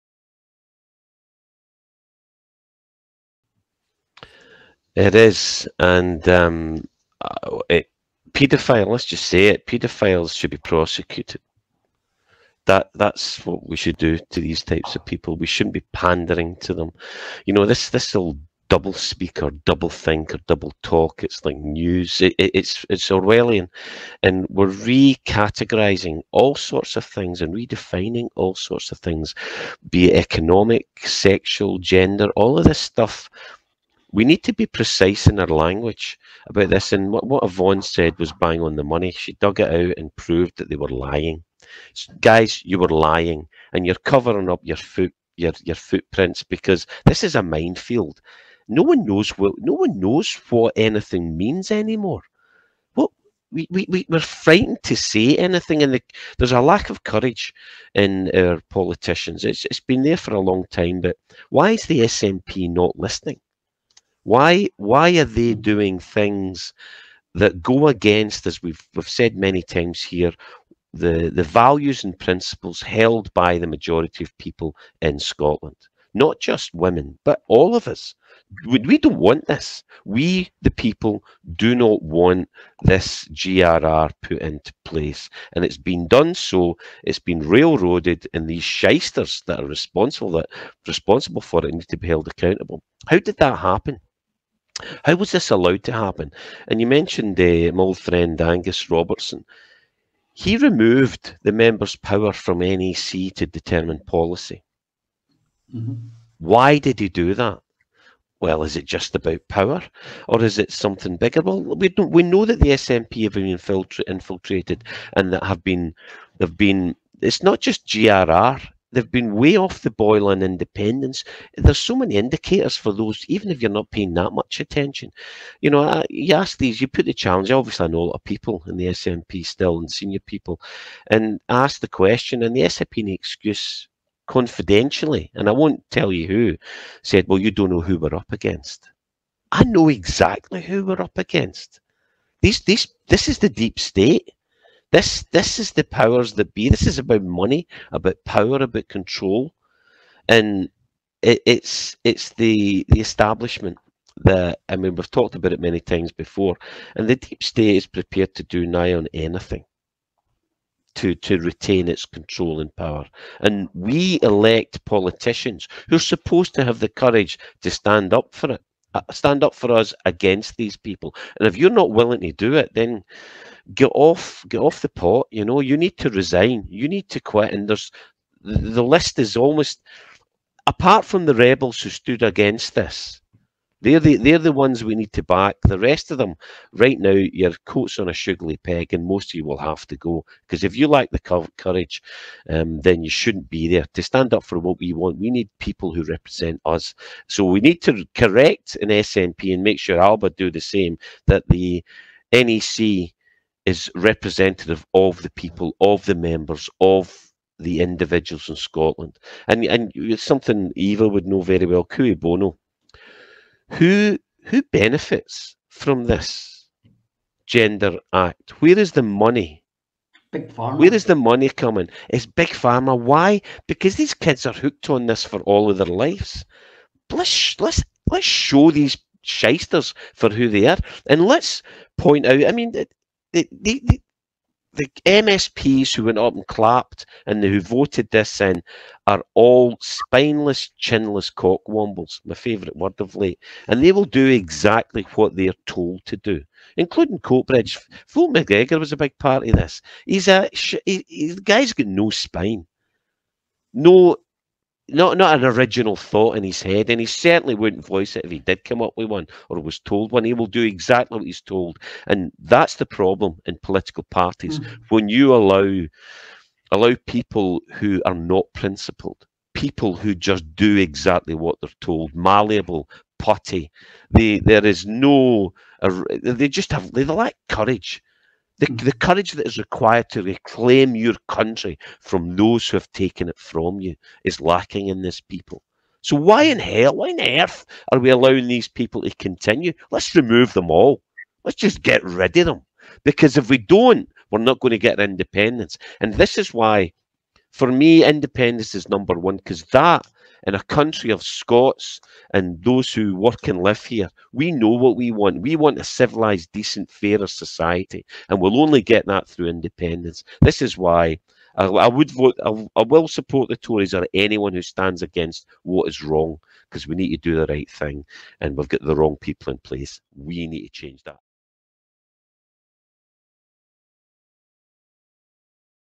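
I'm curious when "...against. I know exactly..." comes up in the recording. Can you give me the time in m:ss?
2:18.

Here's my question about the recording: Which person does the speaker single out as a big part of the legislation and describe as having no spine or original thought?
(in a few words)
Phil McGregor.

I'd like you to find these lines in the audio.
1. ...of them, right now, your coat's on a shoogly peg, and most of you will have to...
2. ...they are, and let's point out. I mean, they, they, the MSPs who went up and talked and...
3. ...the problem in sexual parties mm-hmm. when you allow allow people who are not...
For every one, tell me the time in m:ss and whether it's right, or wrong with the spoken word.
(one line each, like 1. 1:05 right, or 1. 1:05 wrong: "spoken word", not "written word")
1. 3:06 right
2. 3:50 wrong: "clapped", not "talked"
3. 4:22 wrong: "political", not "sexual".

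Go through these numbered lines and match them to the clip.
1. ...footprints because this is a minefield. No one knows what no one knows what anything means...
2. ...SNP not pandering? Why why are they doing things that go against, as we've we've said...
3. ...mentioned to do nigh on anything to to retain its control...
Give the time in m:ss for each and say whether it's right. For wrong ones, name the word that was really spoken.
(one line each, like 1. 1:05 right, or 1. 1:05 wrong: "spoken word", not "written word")
1. 0:45 right
2. 1:02 wrong: "listening", not "pandering"
3. 2:37 wrong: "prepared", not "mentioned".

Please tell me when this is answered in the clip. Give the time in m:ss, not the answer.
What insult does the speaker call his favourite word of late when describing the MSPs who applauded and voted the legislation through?
4:01.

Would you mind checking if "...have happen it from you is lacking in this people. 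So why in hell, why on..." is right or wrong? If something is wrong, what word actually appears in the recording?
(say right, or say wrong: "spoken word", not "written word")
wrong: "taken", not "happen".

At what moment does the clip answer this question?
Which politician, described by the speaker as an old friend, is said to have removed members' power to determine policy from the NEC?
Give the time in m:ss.
1:38.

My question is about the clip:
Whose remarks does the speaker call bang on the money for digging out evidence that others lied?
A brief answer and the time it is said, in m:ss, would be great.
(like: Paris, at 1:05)
Yvonne, at 0:37.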